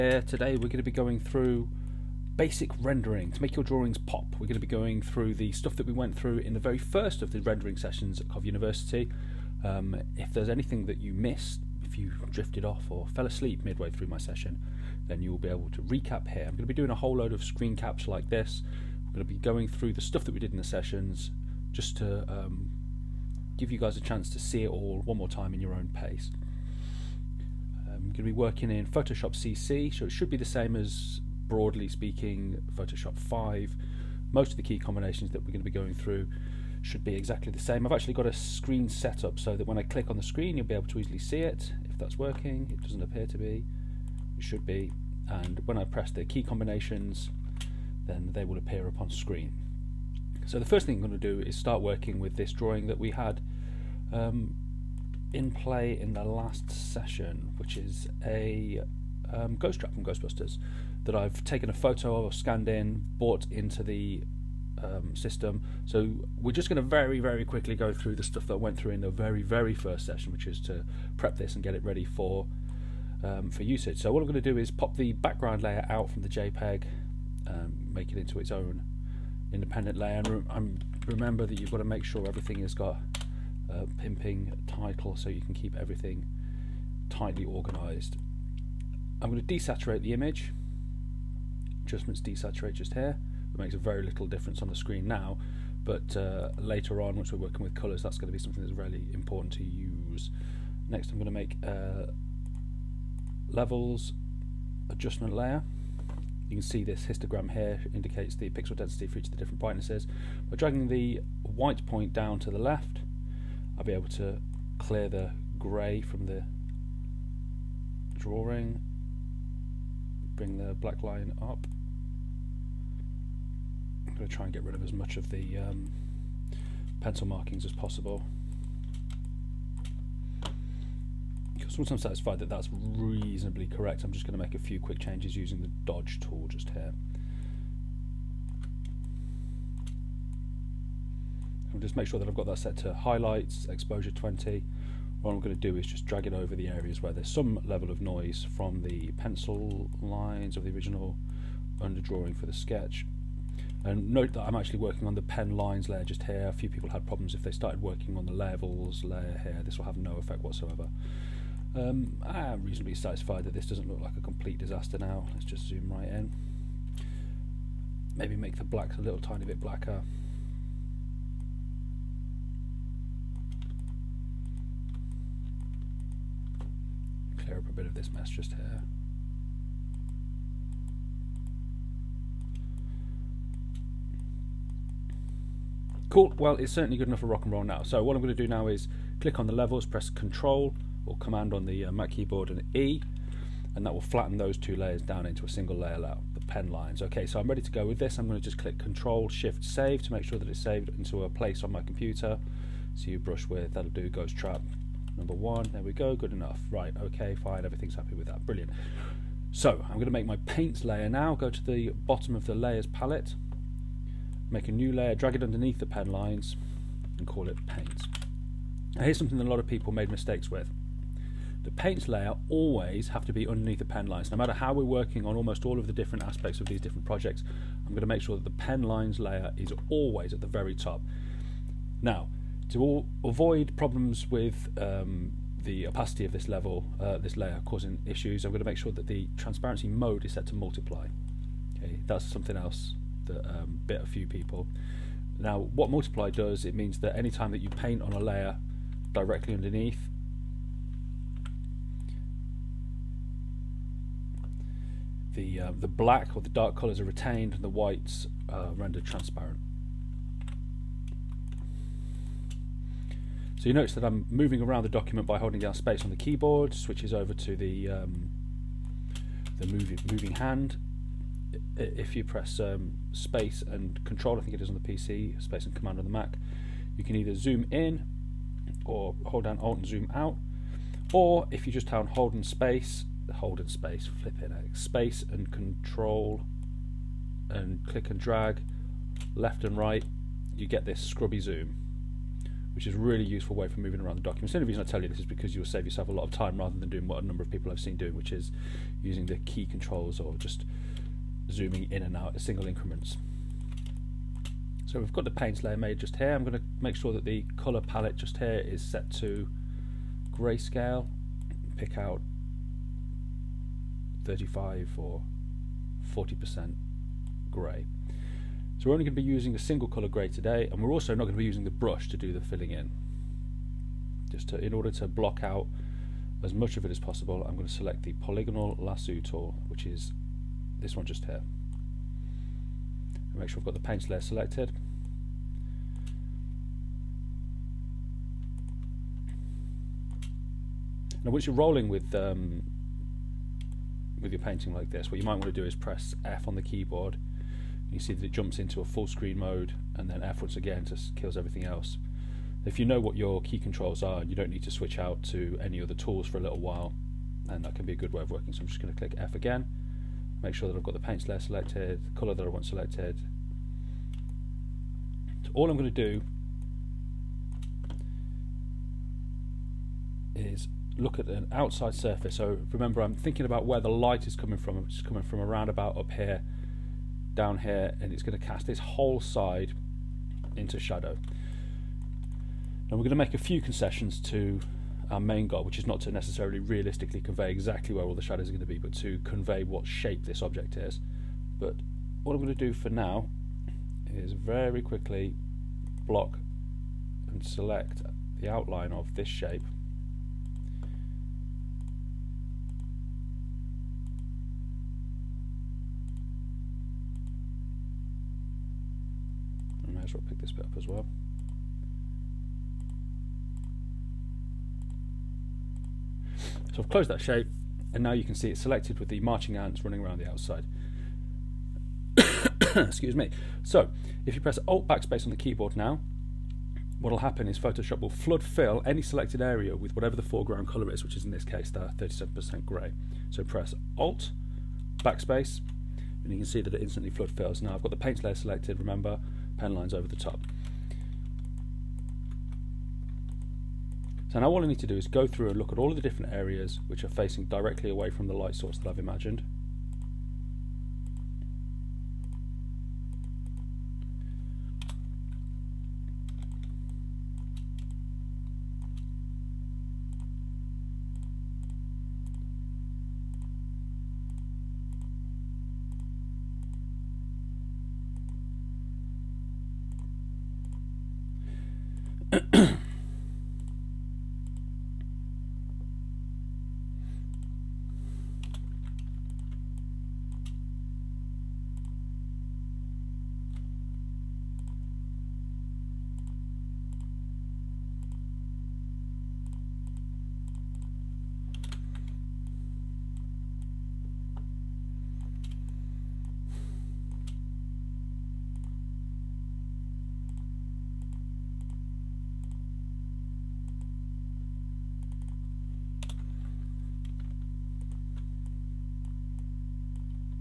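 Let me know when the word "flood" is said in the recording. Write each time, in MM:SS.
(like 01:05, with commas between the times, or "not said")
07:08, 07:17.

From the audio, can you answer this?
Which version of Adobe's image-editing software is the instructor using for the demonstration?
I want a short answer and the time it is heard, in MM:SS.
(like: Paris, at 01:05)
Photoshop CC, at 00:28.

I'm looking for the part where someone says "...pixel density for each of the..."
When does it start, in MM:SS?
01:48.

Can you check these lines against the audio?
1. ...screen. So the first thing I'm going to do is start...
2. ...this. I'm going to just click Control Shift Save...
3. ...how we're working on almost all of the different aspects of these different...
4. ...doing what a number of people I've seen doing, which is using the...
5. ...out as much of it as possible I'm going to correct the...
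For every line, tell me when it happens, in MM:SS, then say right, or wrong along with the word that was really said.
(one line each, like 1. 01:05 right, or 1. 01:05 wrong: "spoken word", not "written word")
1. 00:49 right
2. 03:17 right
3. 03:44 right
4. 04:56 right
5. 05:25 wrong: "select", not "correct".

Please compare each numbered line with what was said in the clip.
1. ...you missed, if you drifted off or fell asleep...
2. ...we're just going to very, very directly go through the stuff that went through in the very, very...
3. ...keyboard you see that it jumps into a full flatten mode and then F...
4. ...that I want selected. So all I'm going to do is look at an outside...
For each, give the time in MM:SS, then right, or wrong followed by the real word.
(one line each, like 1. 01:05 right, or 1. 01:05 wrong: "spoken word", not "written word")
1. 00:10 right
2. 01:06 wrong: "quickly", not "directly"
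3. 05:46 wrong: "screen", not "flatten"
4. 06:02 right.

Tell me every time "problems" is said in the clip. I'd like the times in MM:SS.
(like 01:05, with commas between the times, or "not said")
02:37, 03:53.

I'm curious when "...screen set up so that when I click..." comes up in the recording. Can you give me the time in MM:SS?
00:38.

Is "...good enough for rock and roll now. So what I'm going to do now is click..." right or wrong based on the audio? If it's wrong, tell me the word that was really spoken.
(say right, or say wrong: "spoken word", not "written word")
right.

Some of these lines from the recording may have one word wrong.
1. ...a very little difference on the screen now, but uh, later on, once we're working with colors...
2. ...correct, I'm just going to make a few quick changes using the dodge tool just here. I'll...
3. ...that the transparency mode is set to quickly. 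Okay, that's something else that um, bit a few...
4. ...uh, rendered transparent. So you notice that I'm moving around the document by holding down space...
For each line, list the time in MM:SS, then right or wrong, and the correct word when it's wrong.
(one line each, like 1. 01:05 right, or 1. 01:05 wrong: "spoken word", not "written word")
1. 01:33 right
2. 02:13 right
3. 03:58 wrong: "multiply", not "quickly"
4. 04:18 right.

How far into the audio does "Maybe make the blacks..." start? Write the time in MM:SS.
02:48.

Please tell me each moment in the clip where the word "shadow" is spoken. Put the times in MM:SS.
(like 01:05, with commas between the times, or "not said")
06:20, 06:28.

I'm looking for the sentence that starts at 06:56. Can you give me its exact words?
So I've closed that shape and now you can see it's selected with the marching ants running around the outside.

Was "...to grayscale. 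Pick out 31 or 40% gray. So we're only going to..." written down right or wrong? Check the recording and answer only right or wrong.
wrong.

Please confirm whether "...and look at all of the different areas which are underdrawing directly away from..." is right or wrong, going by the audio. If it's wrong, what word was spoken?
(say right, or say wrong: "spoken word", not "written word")
wrong: "facing", not "underdrawing".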